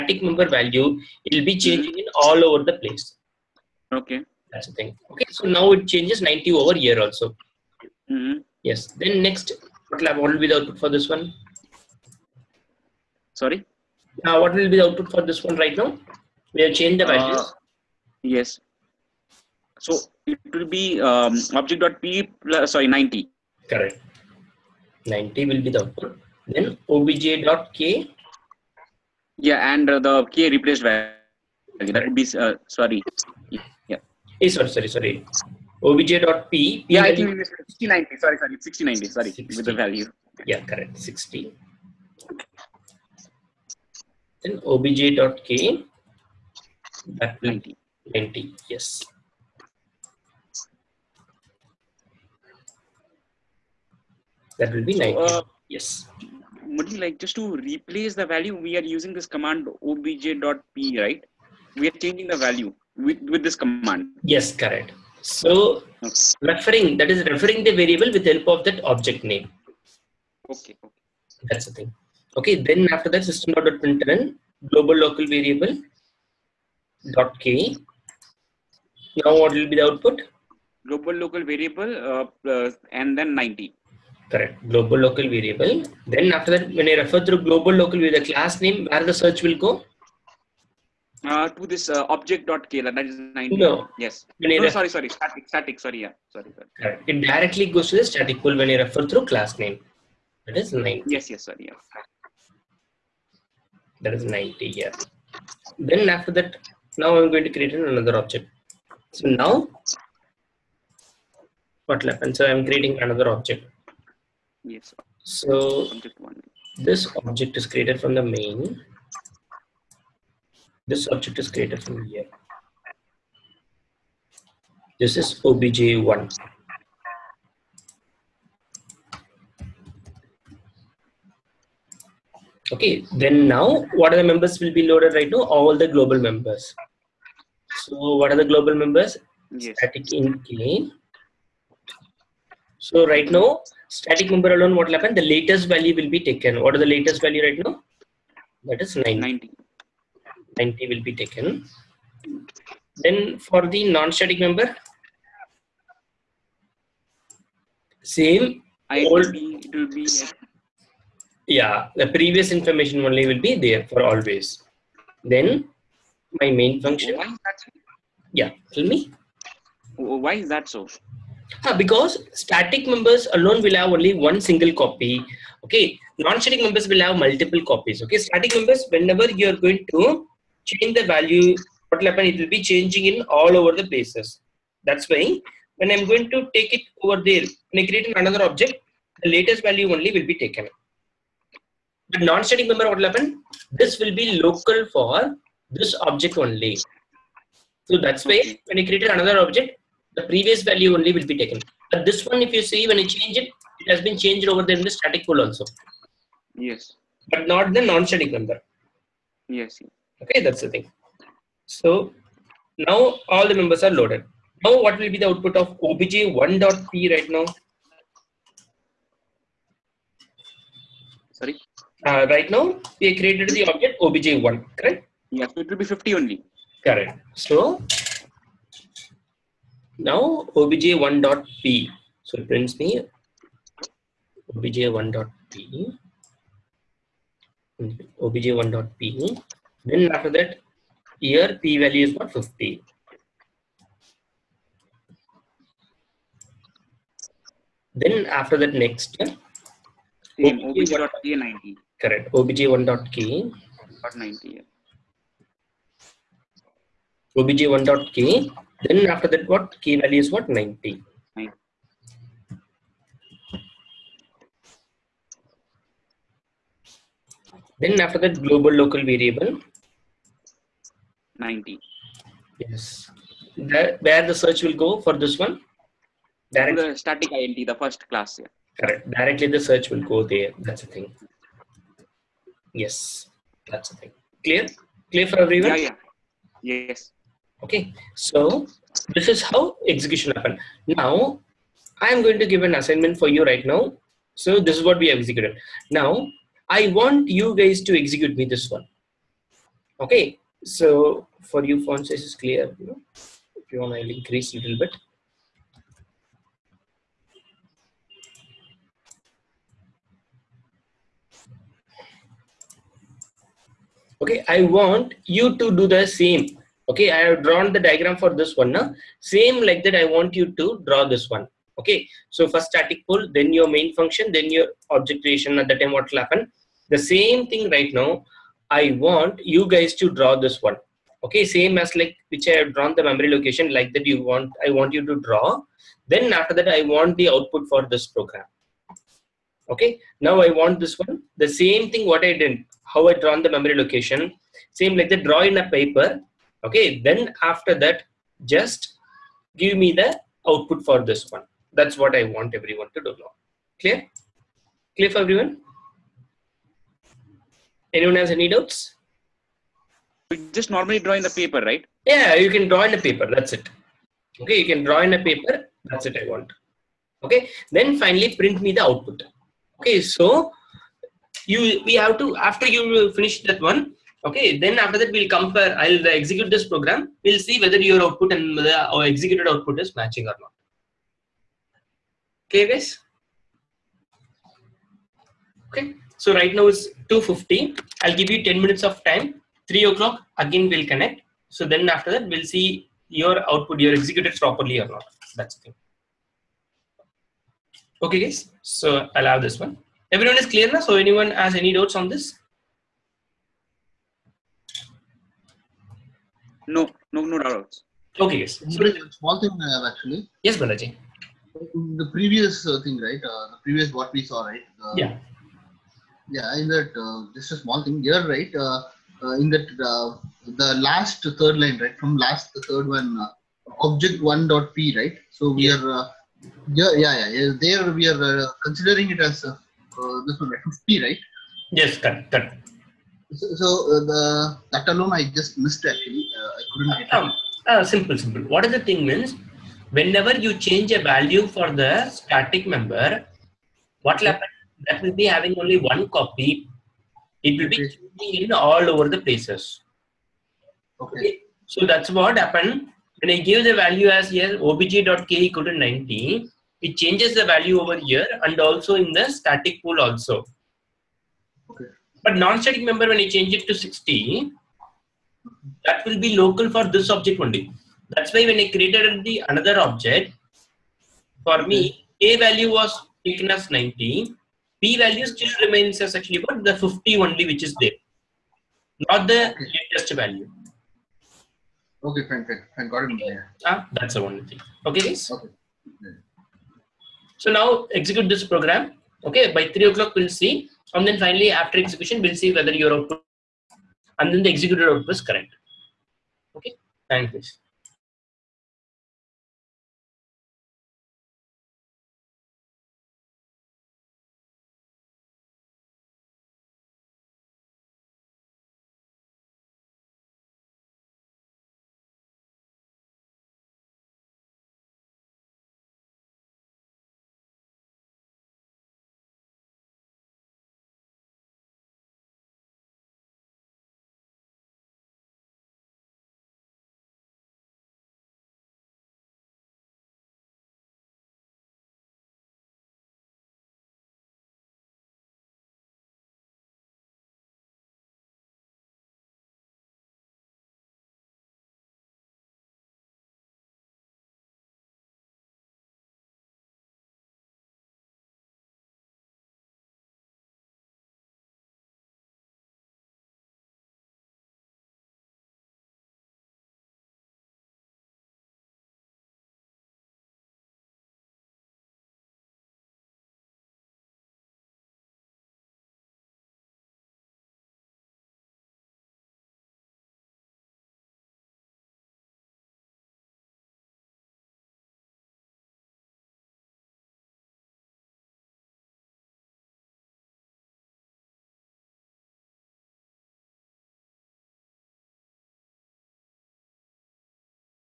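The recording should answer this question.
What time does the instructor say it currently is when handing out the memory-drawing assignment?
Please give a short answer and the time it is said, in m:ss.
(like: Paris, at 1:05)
2.50, at 6:27.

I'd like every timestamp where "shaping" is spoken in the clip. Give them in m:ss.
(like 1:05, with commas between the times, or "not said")
not said.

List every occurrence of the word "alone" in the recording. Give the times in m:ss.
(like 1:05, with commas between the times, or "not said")
2:24, 2:53, 7:14.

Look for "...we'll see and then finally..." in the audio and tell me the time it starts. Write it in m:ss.
8:10.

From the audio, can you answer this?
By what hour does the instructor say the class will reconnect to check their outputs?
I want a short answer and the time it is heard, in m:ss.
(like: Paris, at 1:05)
3 o'clock, at 6:29.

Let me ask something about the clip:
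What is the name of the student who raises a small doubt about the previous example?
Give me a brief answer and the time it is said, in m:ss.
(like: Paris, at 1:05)
Balaji, at 6:50.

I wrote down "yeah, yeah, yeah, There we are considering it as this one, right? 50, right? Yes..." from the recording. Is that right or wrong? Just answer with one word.
right.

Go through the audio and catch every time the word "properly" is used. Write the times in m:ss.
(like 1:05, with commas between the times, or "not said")
6:34.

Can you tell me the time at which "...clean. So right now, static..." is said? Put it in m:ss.
2:20.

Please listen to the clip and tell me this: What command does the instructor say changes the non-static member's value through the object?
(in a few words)
obj.p.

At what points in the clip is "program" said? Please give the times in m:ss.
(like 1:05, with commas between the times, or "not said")
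5:38, 6:16, 8:08.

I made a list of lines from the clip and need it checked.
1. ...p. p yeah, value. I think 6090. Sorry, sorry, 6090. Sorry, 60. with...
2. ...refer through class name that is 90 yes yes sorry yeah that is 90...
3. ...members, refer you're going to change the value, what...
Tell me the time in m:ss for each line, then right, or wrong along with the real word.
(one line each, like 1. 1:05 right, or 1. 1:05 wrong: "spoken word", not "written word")
1. 0:36 right
2. 1:38 right
3. 2:58 wrong: "whenever", not "refer".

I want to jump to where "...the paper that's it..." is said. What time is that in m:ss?
6:02.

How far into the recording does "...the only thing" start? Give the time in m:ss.
8:04.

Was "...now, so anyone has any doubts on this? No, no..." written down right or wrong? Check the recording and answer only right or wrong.
right.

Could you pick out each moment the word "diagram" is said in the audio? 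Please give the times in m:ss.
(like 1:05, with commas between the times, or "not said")
5:17.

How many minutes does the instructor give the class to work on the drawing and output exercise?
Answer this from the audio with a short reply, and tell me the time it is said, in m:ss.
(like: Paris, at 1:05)
10 minutes, at 6:28.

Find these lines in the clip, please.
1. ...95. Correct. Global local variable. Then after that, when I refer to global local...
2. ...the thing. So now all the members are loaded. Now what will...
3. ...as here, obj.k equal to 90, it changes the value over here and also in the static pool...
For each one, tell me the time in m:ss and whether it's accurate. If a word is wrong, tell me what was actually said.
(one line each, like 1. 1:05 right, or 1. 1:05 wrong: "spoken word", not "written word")
1. 1:23 wrong: "90", not "95"
2. 3:30 right
3. 7:34 right.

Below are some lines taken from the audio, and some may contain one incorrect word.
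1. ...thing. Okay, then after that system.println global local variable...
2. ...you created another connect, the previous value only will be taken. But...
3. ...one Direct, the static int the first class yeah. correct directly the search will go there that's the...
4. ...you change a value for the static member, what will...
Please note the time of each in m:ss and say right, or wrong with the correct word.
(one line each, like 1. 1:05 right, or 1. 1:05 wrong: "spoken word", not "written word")
1. 1:11 right
2. 3:18 wrong: "object", not "connect"
3. 4:35 right
4. 7:20 right.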